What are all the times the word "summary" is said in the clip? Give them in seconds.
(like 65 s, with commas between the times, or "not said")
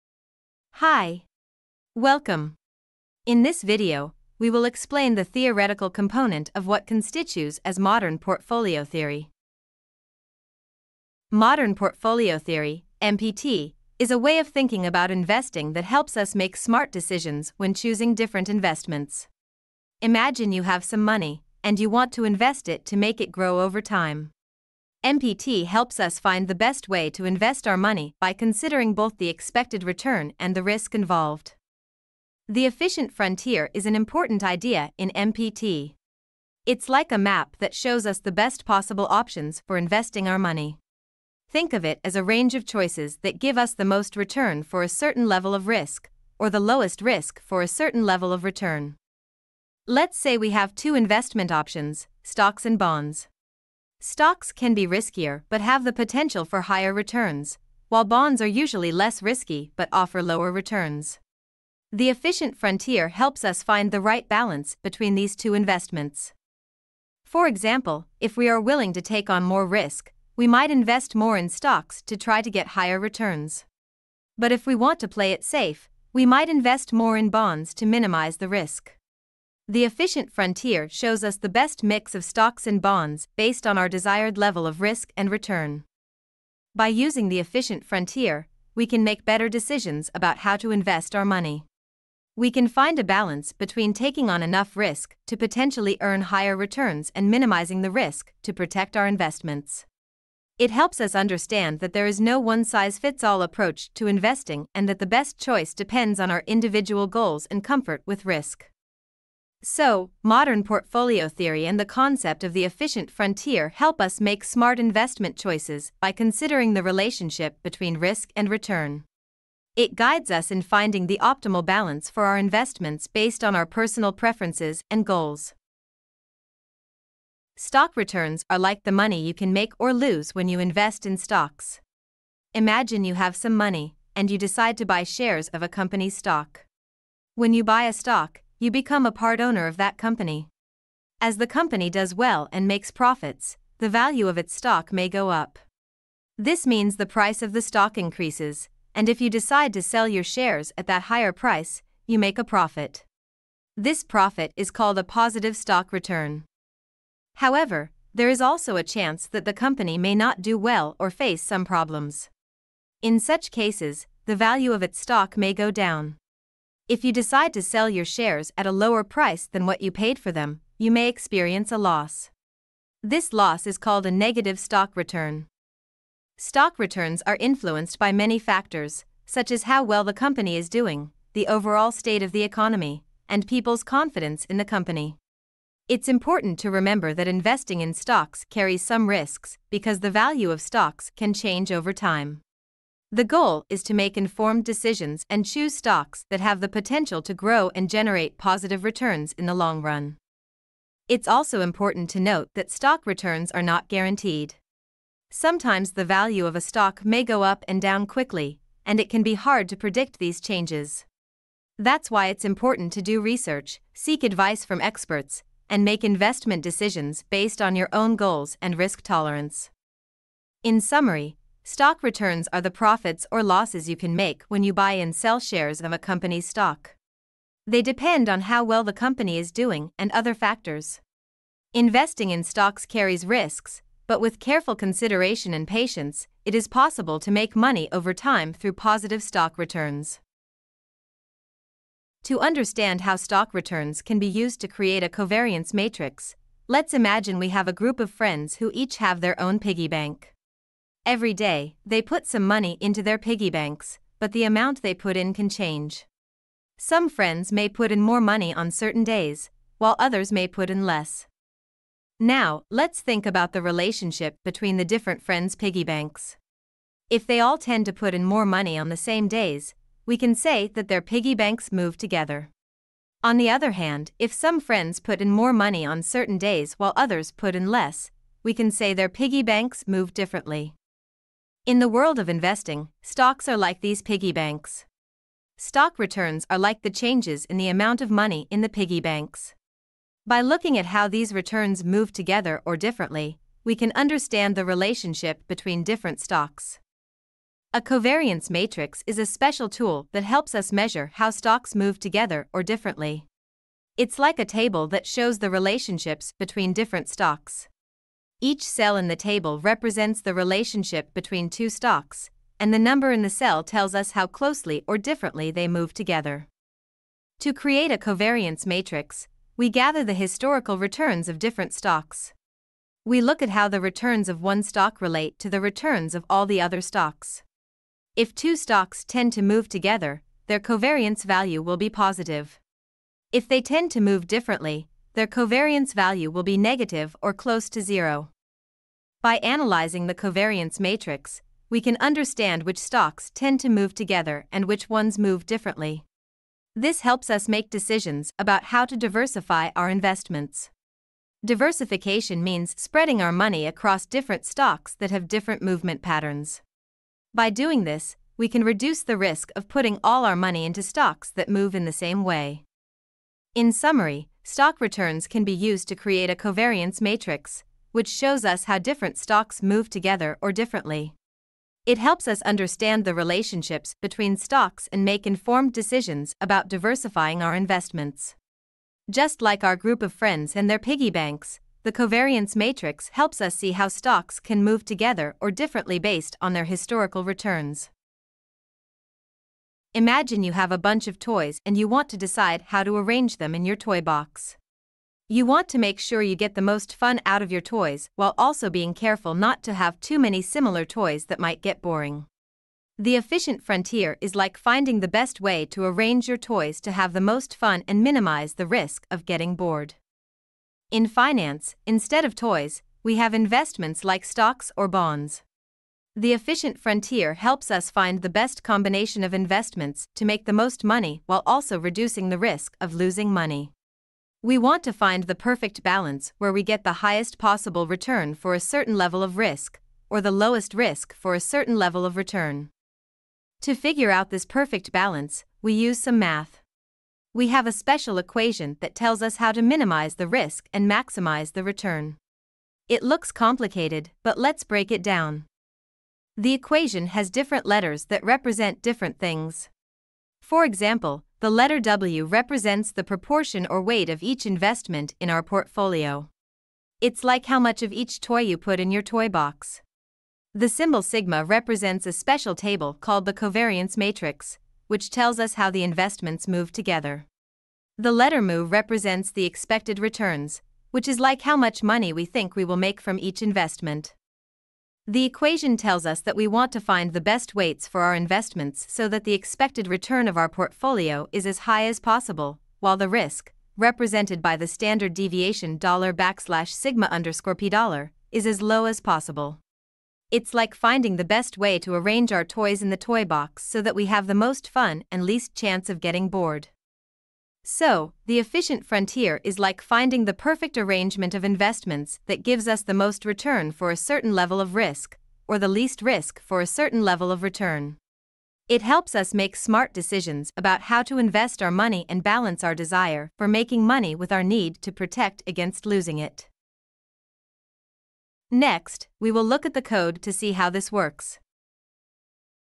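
220 s, 363 s.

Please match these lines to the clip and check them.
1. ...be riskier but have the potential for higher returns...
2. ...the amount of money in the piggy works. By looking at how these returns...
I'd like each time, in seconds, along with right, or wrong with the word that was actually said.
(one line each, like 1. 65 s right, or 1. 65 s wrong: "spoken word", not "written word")
1. 54 s right
2. 287 s wrong: "banks", not "works".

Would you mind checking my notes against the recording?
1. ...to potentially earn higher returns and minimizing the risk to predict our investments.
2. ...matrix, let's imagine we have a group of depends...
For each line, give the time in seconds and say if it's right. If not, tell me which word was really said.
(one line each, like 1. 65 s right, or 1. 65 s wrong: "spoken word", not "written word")
1. 95 s wrong: "protect", not "predict"
2. 245 s wrong: "friends", not "depends".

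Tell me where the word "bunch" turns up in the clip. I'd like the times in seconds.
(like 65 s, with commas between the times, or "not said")
390 s.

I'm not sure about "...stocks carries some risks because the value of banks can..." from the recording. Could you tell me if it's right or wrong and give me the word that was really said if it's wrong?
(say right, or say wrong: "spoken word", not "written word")
wrong: "stocks", not "banks".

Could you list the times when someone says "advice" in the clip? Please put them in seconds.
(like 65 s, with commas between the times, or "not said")
214 s.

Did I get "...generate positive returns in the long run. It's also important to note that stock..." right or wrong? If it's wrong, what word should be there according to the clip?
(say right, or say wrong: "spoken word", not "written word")
right.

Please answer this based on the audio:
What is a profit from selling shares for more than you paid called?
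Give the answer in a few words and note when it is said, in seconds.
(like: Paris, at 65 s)
Positive stock return, at 155 s.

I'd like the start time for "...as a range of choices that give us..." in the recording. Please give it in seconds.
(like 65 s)
42 s.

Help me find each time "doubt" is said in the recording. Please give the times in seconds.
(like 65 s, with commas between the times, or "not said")
not said.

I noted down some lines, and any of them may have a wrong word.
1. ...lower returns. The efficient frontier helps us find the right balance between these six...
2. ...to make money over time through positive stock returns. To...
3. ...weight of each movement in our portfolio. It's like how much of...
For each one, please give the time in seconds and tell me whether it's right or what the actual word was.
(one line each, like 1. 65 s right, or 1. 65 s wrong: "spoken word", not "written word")
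1. 60 s wrong: "two", not "six"
2. 237 s right
3. 453 s wrong: "investment", not "movement".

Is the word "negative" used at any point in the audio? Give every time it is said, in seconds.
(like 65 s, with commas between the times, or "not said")
174 s, 336 s.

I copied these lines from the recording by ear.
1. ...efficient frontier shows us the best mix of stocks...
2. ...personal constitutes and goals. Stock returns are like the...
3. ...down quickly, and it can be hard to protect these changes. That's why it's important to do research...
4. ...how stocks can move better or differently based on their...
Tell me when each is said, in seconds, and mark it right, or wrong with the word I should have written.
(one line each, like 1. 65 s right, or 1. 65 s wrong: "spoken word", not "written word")
1. 79 s right
2. 123 s wrong: "preferences", not "constitutes"
3. 207 s wrong: "predict", not "protect"
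4. 383 s wrong: "together", not "better".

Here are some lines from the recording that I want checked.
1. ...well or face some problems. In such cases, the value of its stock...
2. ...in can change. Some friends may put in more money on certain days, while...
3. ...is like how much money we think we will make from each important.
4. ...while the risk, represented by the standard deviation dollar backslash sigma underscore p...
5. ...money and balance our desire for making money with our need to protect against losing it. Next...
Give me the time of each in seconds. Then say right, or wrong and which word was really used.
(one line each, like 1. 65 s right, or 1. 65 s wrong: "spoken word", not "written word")
1. 160 s right
2. 255 s right
3. 471 s wrong: "investment", not "important"
4. 482 s right
5. 511 s right.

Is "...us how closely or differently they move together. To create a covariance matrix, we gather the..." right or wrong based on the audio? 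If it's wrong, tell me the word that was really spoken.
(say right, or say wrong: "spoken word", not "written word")
right.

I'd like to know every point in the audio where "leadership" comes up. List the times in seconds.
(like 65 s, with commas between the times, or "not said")
not said.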